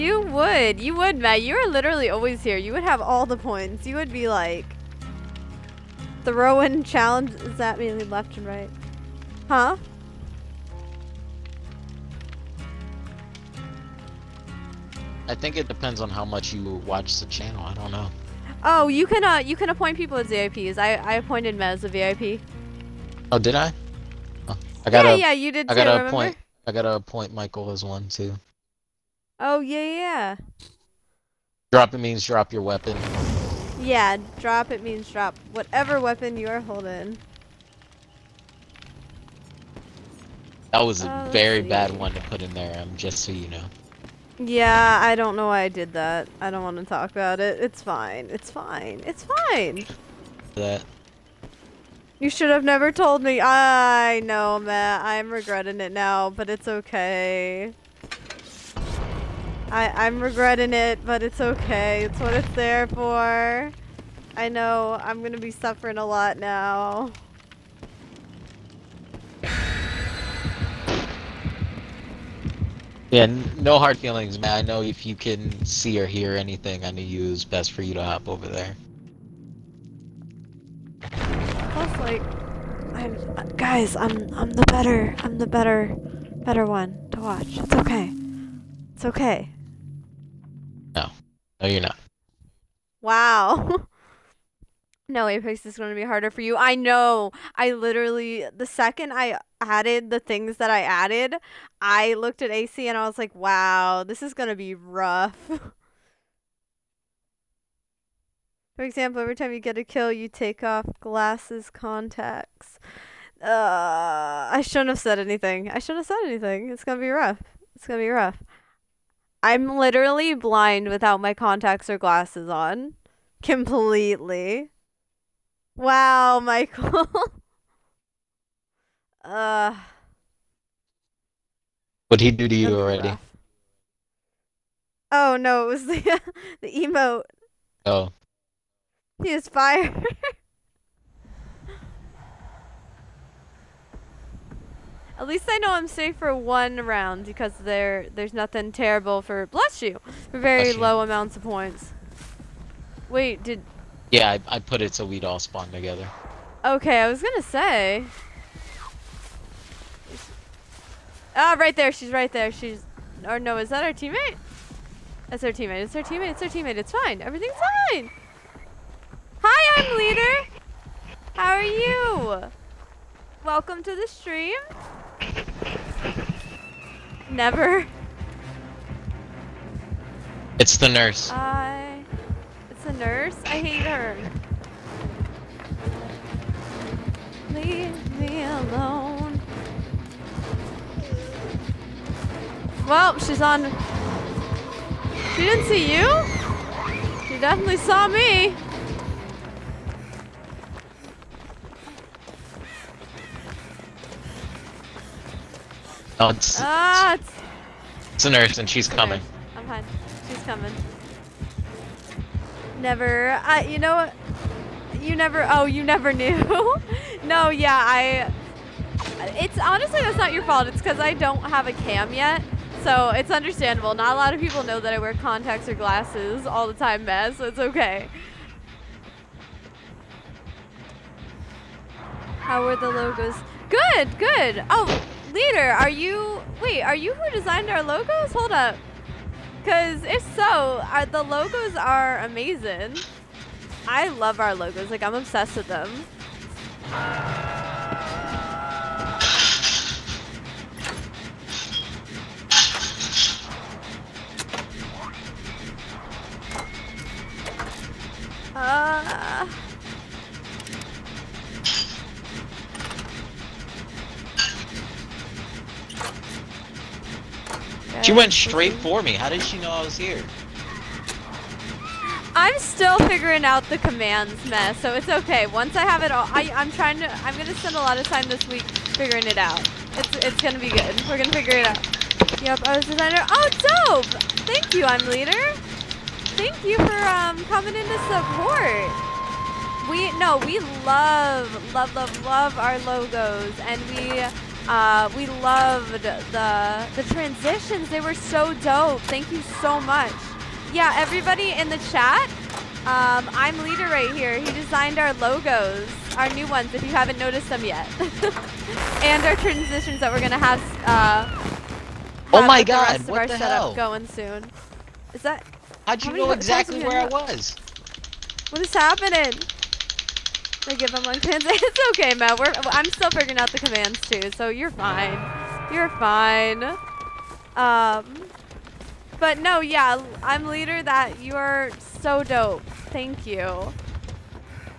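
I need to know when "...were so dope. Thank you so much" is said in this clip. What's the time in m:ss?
4:57.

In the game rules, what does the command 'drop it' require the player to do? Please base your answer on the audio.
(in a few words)
drop your weapon.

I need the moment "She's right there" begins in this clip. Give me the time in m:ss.
2:41.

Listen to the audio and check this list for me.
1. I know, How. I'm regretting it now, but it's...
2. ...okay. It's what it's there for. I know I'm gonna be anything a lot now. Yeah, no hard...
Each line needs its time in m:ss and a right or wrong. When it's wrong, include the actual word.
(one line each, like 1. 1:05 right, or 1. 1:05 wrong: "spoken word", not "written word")
1. 0:53 wrong: "Matt", not "How"
2. 1:01 wrong: "suffering", not "anything".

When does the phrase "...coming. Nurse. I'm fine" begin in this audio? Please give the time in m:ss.
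3:28.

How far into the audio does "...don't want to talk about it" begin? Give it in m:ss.
0:46.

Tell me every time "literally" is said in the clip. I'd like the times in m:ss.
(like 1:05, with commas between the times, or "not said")
0:01, 1:37, 1:59.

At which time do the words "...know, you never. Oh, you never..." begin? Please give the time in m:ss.
3:33.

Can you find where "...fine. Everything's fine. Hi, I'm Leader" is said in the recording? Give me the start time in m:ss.
2:46.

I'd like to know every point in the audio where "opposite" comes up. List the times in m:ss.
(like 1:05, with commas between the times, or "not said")
not said.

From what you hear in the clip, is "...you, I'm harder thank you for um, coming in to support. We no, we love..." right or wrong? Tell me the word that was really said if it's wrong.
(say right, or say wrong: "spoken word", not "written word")
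wrong: "leader", not "harder".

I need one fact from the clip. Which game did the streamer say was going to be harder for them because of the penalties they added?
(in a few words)
Apex.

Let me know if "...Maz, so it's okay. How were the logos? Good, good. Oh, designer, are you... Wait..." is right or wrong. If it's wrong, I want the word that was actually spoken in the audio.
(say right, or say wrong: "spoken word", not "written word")
wrong: "leader", not "designer".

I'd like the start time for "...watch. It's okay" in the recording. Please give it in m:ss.
1:27.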